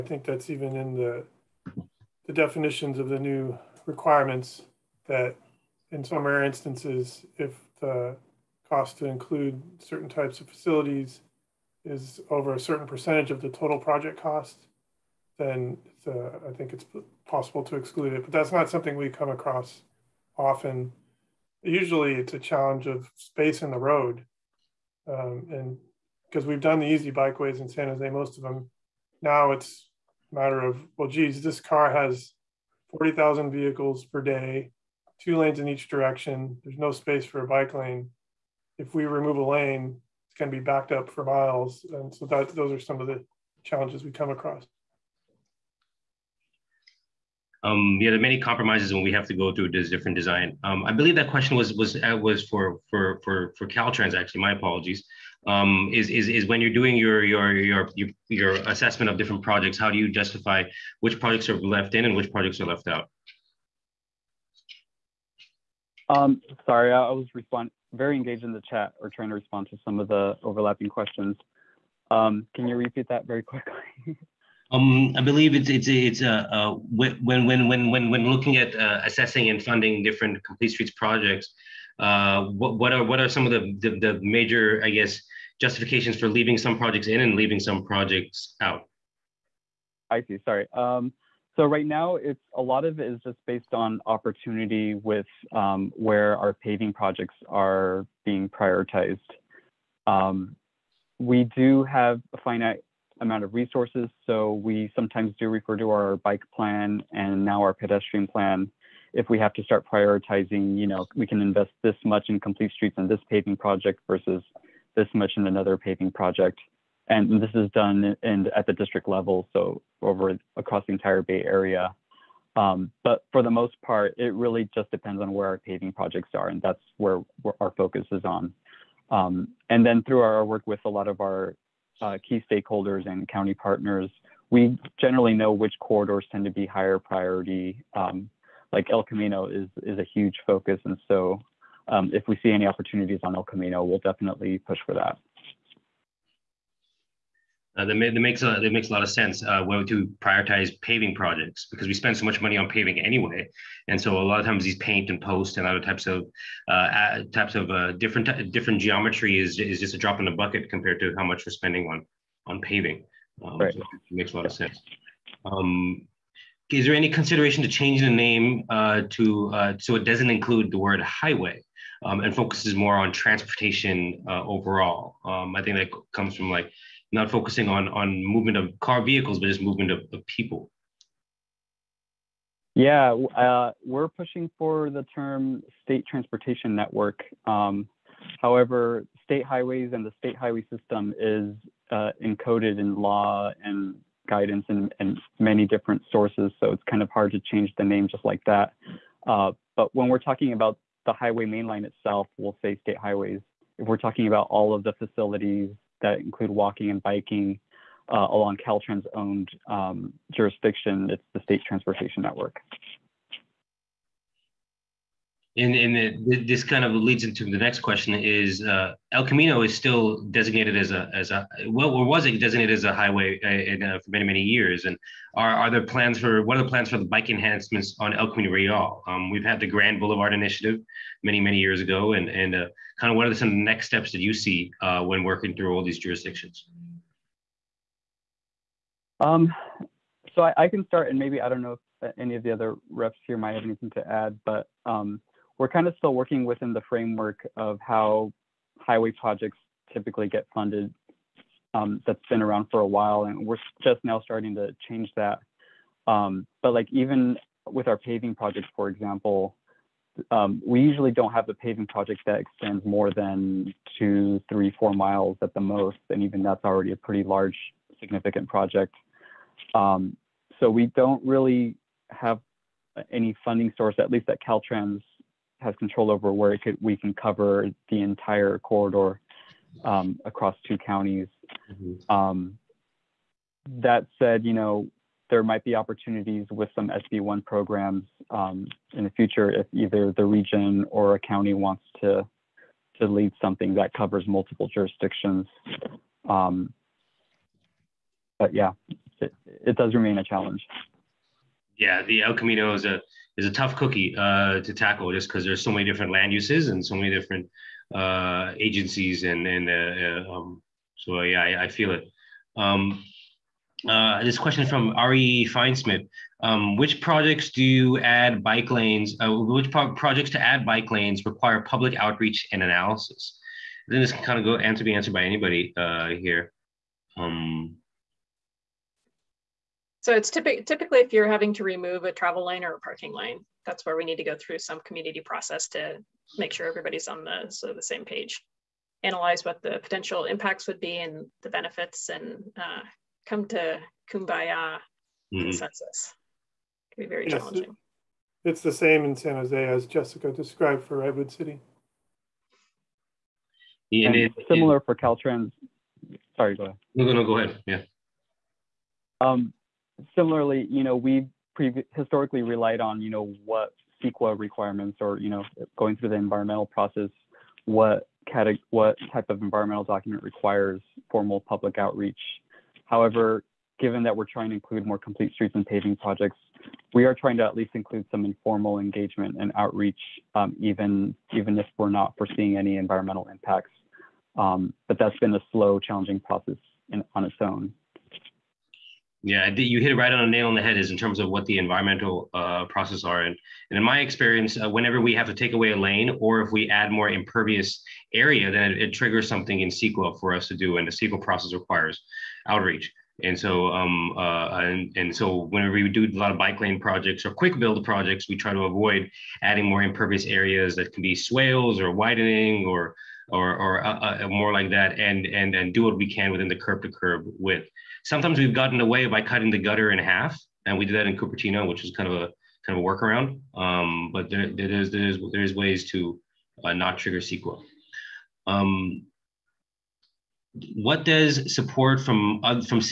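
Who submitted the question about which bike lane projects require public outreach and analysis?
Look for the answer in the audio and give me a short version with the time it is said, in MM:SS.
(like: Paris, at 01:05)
Ari Feinsmith, at 05:14.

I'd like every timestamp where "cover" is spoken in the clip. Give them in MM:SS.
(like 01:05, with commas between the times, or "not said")
04:37, 04:53.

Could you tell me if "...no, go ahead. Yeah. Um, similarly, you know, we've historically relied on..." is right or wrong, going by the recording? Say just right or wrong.
right.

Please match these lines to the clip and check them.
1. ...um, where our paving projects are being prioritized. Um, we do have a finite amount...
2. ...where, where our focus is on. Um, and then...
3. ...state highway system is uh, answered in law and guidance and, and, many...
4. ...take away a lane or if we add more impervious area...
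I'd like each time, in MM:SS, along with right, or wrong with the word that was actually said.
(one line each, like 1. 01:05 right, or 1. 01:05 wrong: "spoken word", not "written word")
1. 01:35 right
2. 02:06 right
3. 03:10 wrong: "encoded", not "answered"
4. 06:35 right.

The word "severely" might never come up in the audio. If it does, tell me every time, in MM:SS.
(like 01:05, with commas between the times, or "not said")
not said.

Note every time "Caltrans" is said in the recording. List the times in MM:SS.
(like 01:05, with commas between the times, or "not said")
00:53, 03:28, 04:34, 05:54.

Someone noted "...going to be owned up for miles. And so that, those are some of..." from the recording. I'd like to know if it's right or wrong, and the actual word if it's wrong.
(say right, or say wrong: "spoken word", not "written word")
wrong: "backed", not "owned".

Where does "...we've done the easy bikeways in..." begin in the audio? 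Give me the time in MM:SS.
00:26.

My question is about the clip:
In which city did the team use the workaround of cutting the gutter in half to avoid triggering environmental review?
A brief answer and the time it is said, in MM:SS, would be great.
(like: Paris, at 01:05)
Cupertino, at 07:01.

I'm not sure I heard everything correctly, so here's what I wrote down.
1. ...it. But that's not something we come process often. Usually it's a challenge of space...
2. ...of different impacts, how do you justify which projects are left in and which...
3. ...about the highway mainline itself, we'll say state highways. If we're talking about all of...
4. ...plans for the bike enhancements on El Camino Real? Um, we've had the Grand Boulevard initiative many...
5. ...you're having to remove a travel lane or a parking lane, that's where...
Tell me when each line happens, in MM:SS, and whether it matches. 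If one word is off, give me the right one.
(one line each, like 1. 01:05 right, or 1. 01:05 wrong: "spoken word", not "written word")
1. 00:18 wrong: "across", not "process"
2. 00:59 wrong: "projects", not "impacts"
3. 03:20 right
4. 03:46 right
5. 05:31 right.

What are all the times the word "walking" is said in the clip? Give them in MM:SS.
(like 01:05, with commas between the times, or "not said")
03:26.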